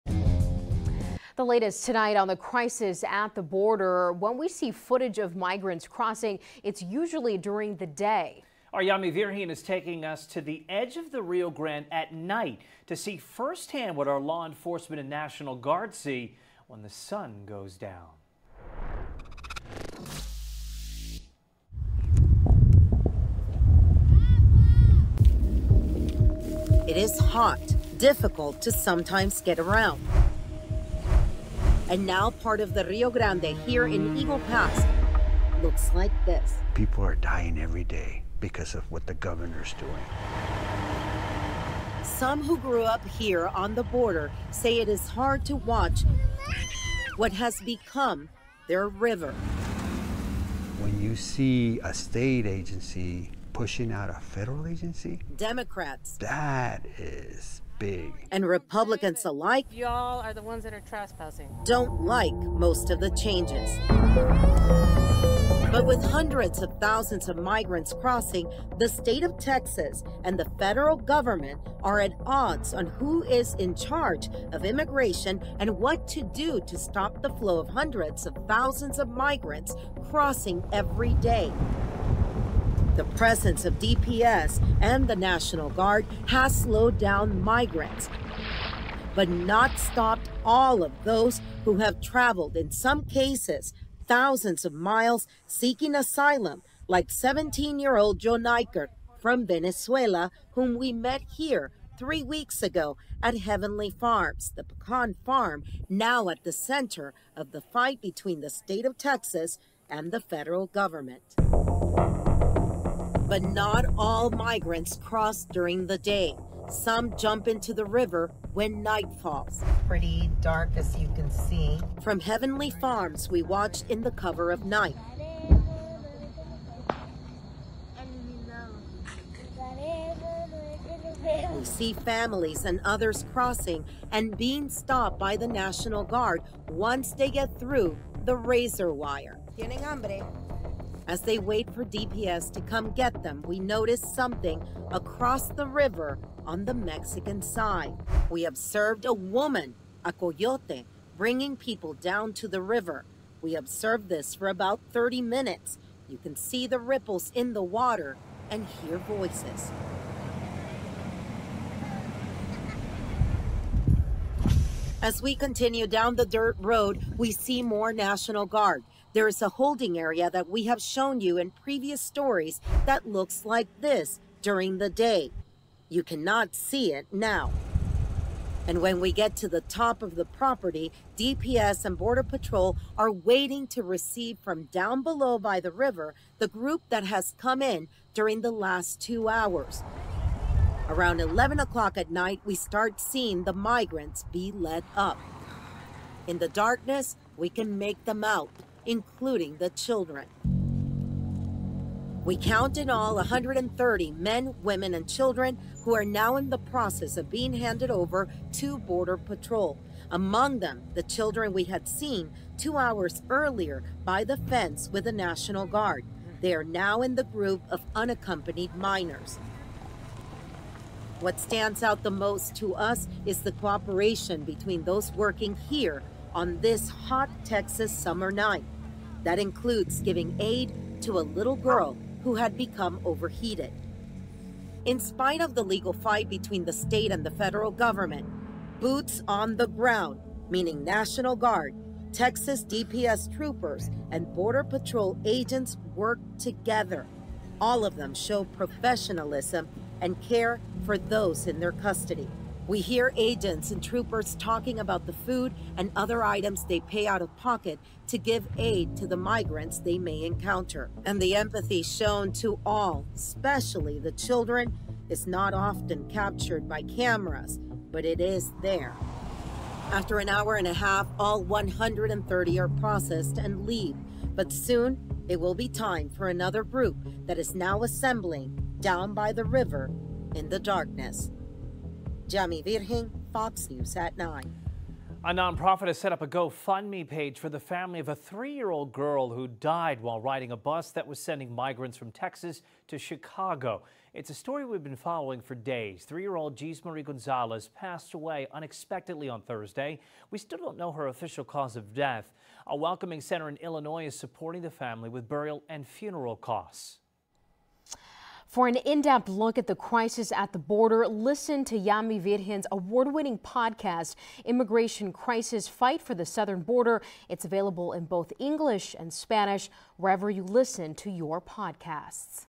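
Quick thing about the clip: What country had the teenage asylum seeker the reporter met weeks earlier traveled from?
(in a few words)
Venezuela.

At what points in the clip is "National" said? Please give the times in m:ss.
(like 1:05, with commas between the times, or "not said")
0:15, 1:25, 2:15, 2:47, 3:35, 4:00.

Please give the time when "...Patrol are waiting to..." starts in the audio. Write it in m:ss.
3:02.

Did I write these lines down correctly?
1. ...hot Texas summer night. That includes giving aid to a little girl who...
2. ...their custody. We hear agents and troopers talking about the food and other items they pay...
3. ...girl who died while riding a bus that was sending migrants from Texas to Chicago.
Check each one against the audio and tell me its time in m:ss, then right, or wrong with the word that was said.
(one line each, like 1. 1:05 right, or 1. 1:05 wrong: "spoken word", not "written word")
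1. 3:46 right
2. 4:11 right
3. 4:48 right.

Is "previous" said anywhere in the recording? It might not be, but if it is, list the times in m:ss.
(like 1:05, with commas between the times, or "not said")
2:51.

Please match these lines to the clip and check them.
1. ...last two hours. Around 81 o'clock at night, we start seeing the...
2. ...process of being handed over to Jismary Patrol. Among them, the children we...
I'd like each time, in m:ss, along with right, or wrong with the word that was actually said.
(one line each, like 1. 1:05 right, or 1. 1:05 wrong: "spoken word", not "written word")
1. 3:08 wrong: "11", not "81"
2. 3:26 wrong: "Border", not "Jismary".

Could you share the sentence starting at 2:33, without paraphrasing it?
We observed this for about 30 minutes.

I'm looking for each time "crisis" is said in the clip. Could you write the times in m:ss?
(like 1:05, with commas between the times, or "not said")
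0:02, 5:09, 5:15.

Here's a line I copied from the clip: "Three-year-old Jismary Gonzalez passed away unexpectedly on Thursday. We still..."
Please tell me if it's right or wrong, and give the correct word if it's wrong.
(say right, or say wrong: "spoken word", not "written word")
right.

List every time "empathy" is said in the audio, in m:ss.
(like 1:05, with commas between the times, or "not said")
4:21.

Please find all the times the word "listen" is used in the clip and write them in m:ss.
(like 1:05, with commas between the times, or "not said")
5:11, 5:20.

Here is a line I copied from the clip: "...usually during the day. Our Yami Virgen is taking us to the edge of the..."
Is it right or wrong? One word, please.
right.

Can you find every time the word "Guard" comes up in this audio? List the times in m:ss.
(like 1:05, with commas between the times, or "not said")
0:15, 1:25, 2:16, 2:48, 3:35, 4:01.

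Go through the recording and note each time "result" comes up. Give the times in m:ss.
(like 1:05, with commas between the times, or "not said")
not said.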